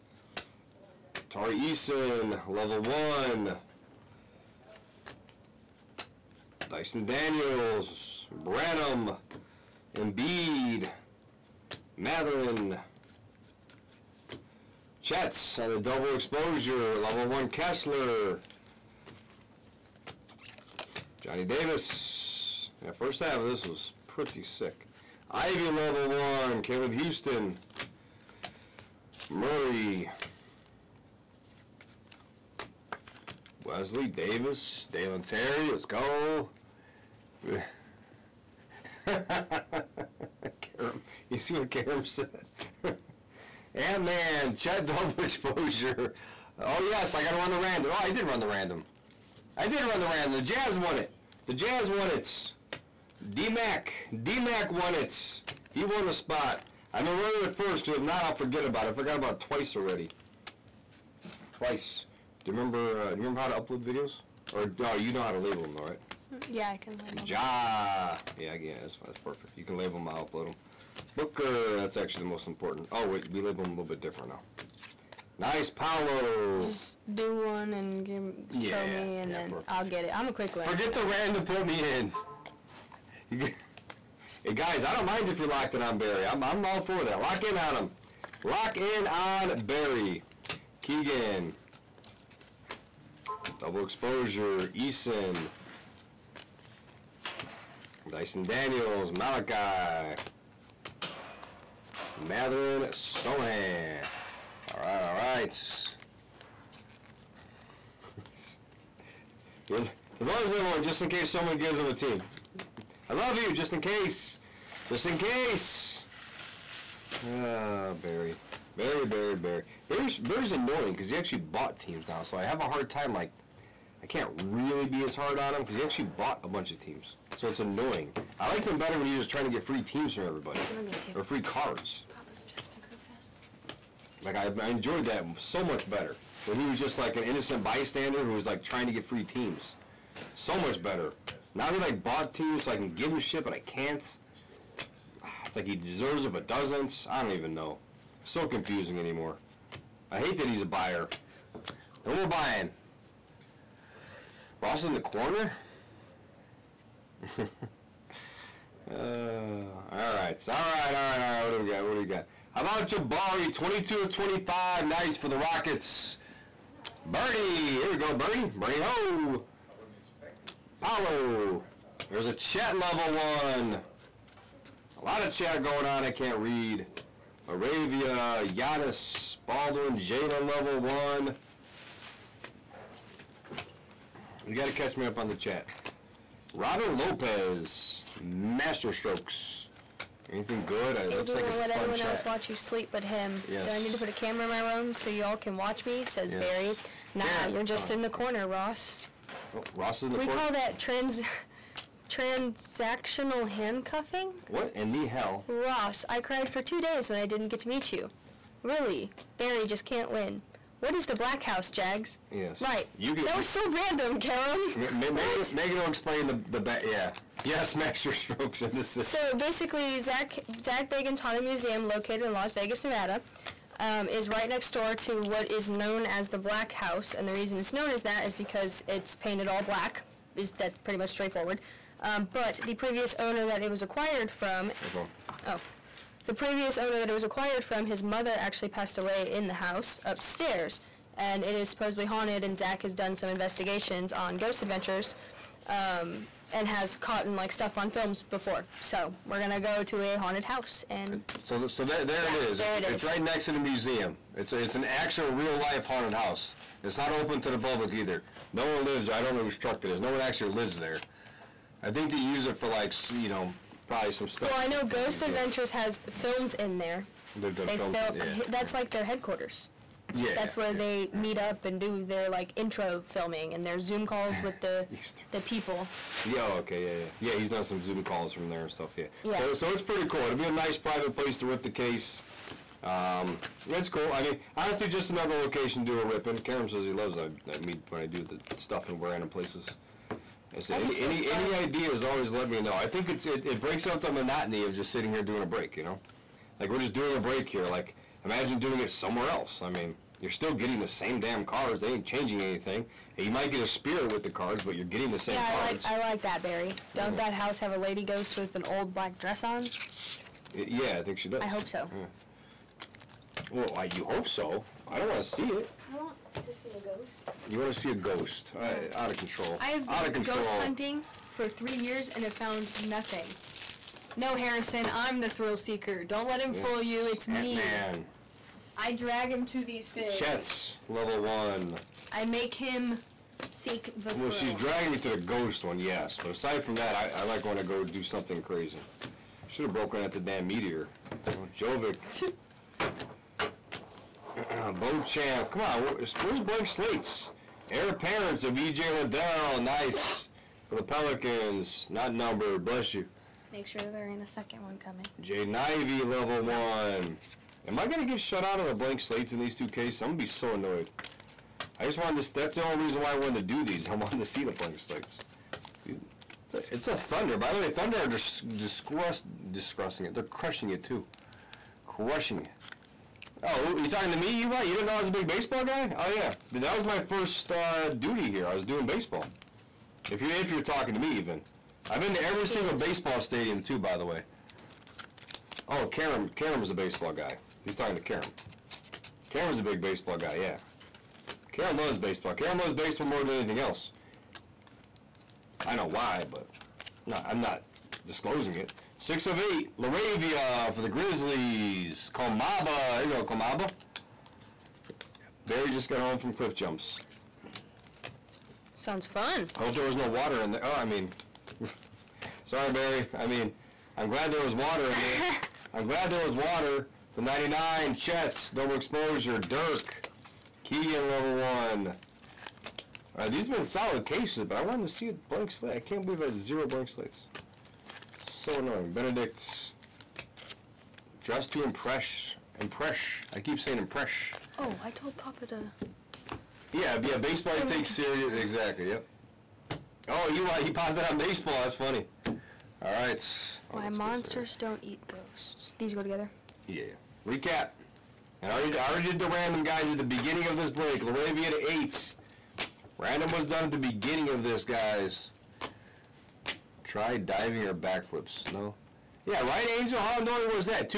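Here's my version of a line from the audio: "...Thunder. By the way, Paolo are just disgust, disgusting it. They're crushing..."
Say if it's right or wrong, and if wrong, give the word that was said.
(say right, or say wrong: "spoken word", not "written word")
wrong: "Thunder", not "Paolo".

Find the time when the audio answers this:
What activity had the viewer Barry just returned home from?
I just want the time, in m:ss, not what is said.
6:46.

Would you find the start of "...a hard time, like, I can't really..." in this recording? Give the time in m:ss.
2:02.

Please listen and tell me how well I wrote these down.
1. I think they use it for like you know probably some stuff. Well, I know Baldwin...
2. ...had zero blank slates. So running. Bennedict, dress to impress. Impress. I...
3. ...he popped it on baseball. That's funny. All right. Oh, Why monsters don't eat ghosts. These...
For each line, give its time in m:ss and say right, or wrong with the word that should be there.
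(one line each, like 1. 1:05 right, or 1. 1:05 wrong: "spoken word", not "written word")
1. 4:21 wrong: "Ghost", not "Baldwin"
2. 7:06 wrong: "annoying", not "running"
3. 7:20 right.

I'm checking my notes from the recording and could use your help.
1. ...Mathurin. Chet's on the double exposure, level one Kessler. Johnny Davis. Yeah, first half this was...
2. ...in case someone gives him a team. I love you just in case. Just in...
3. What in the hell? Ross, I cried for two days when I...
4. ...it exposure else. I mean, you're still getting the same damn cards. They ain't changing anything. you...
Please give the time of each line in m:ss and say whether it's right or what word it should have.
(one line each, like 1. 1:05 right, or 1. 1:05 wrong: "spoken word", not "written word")
1. 0:11 right
2. 1:51 right
3. 3:24 right
4. 4:58 wrong: "somewhere", not "exposure".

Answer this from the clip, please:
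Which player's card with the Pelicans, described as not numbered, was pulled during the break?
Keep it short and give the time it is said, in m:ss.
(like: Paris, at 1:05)
E.J. Liddell, at 5:48.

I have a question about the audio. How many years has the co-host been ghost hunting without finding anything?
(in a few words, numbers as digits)
3.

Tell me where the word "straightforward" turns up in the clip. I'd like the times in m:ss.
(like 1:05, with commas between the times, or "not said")
3:51.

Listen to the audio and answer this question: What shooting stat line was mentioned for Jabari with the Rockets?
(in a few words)
22 of 25.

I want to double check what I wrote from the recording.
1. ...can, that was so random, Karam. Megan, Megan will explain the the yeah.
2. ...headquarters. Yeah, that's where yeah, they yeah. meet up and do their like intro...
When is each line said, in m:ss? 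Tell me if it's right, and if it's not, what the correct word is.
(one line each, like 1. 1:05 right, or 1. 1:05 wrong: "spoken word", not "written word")
1. 3:33 right
2. 4:29 right.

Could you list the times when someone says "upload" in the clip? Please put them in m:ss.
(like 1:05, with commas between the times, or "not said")
1:03, 1:10.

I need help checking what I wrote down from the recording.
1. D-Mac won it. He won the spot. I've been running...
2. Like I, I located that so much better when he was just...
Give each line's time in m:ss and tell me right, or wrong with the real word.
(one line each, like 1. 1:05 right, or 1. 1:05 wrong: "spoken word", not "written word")
1. 0:54 right
2. 2:14 wrong: "enjoyed", not "located".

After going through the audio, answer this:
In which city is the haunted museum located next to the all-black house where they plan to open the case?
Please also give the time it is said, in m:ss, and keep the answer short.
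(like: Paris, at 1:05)
Las Vegas, at 3:42.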